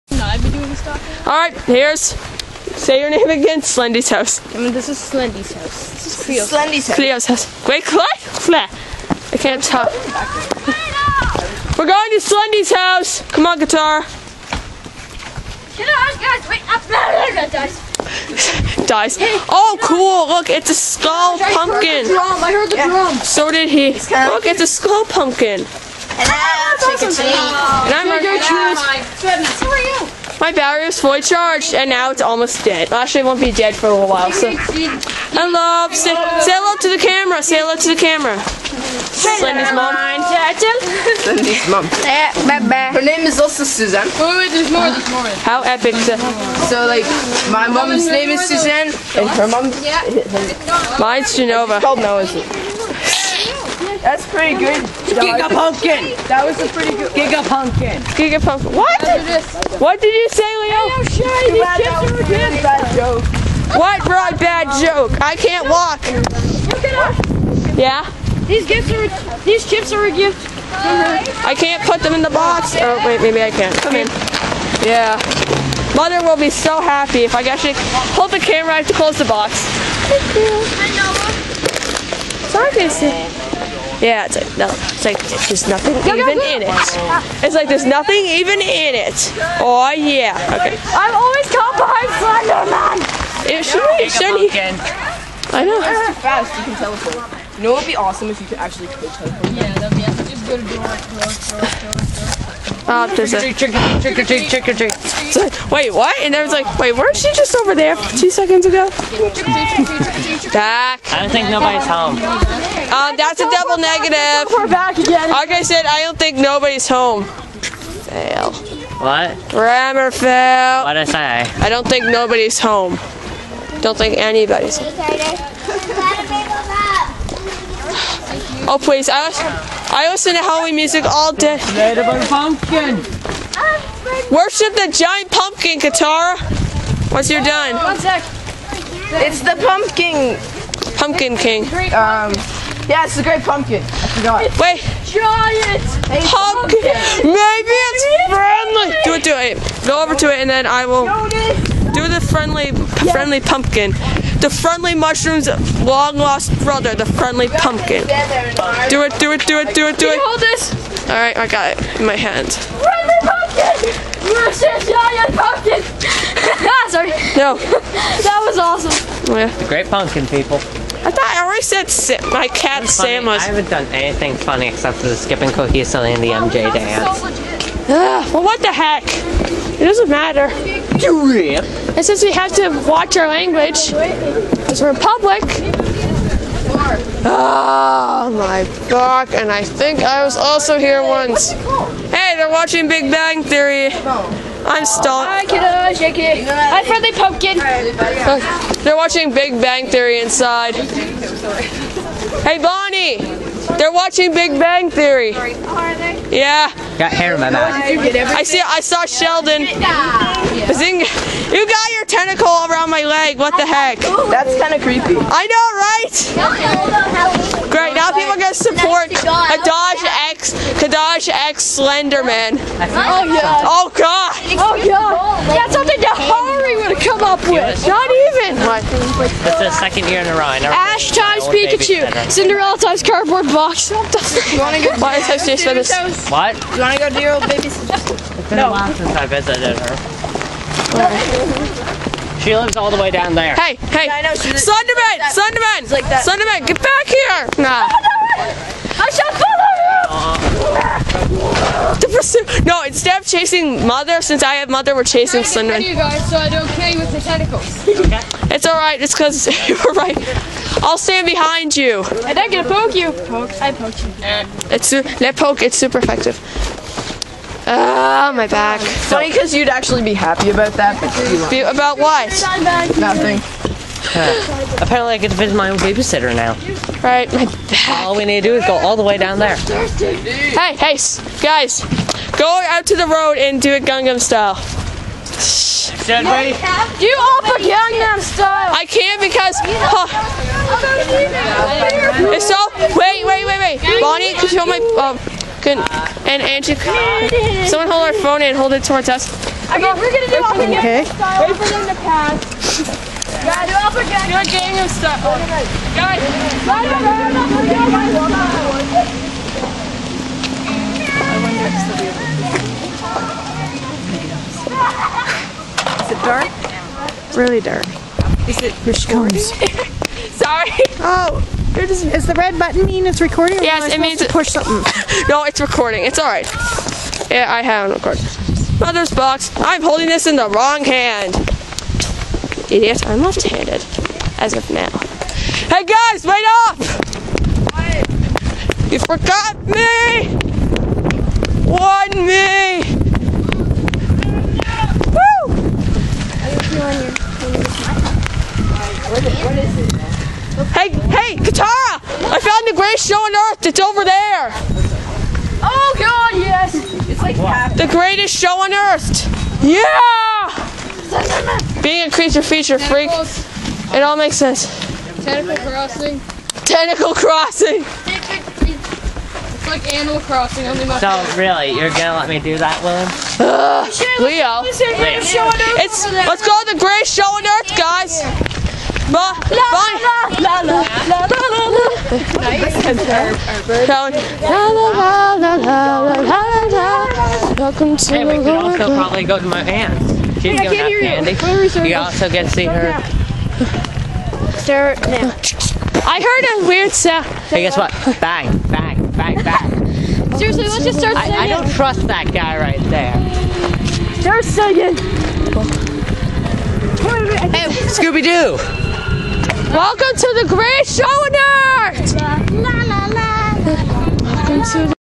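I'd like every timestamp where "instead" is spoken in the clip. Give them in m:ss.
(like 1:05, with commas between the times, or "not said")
4:12.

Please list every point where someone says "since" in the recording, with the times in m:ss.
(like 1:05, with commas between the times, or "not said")
3:02, 3:58, 4:14.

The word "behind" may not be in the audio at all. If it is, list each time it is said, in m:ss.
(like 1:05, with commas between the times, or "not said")
1:31, 4:21.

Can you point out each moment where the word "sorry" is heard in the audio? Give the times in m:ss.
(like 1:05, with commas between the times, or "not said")
1:22, 2:46, 5:20.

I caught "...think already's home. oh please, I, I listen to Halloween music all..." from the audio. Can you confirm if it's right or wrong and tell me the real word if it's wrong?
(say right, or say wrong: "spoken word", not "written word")
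wrong: "anybody", not "already".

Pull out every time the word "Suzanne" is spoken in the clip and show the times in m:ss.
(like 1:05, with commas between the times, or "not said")
0:43, 0:48.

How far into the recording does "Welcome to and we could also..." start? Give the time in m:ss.
6:27.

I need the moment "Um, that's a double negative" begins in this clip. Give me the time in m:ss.
1:52.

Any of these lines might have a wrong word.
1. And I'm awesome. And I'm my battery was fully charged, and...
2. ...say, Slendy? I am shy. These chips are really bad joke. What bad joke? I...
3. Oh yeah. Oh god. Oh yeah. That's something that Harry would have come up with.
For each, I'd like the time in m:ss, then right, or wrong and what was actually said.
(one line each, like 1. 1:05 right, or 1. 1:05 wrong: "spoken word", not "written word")
1. 0:25 right
2. 1:00 wrong: "Leo", not "Slendy"
3. 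3:42 right.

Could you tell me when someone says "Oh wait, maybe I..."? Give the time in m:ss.
1:12.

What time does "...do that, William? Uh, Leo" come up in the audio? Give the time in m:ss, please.
6:12.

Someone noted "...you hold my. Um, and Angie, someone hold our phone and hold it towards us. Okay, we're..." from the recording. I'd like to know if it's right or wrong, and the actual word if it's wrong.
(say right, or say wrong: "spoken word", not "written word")
right.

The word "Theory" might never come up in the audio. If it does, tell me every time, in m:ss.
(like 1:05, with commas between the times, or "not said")
3:13, 3:19, 3:24.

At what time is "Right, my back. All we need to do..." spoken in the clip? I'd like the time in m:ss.
4:37.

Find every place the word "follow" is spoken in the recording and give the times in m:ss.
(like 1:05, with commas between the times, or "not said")
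4:11.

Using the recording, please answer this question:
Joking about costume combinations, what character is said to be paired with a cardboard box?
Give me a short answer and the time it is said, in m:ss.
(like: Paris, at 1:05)
Cinderella, at 3:52.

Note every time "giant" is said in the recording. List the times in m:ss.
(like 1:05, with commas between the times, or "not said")
2:14, 2:25.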